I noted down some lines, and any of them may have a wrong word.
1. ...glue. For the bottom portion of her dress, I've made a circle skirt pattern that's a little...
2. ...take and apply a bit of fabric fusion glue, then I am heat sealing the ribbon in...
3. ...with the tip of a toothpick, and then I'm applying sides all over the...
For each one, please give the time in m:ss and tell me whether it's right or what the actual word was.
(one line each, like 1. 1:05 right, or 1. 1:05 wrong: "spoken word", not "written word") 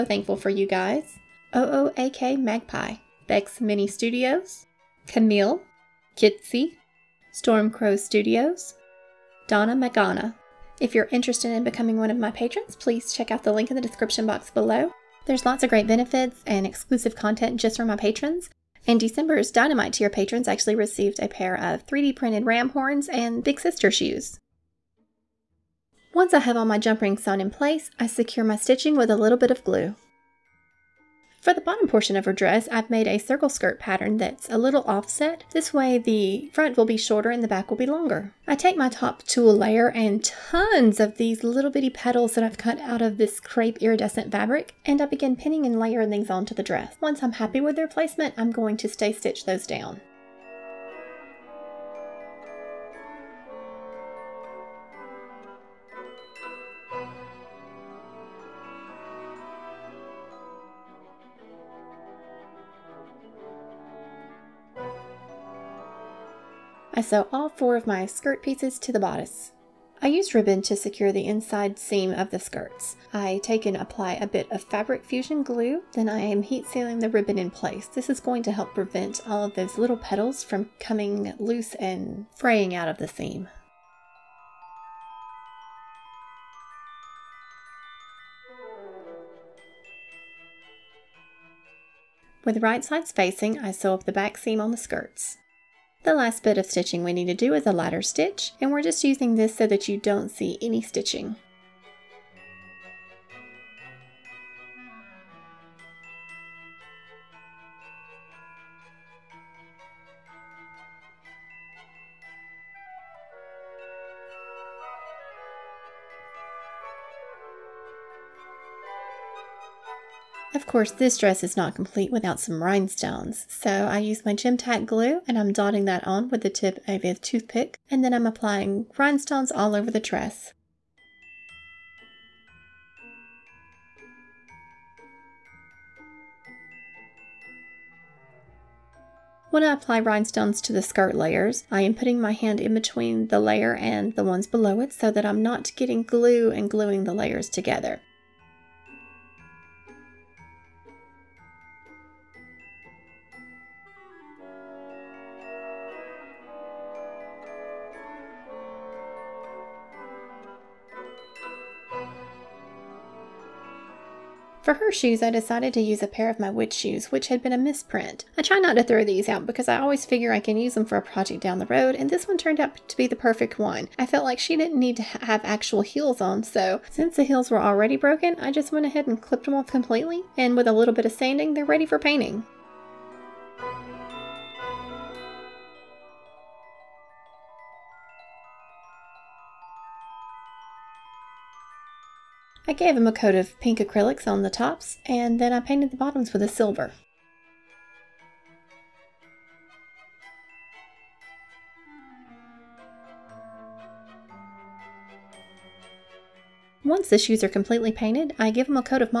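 1. 0:29 right
2. 1:13 right
3. 2:06 wrong: "rhinestones", not "sides".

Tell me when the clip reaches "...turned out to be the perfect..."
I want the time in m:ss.
2:52.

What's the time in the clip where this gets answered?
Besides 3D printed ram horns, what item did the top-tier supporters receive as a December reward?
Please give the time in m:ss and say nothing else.
0:23.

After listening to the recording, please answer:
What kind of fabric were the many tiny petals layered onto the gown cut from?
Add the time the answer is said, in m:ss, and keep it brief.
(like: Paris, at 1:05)
crepe iridescent fabric, at 0:43.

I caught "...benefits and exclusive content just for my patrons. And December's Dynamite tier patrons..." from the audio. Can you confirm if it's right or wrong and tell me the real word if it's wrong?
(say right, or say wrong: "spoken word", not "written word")
right.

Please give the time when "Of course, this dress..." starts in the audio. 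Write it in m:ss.
2:00.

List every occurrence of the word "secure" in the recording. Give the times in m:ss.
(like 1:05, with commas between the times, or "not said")
0:28, 1:10.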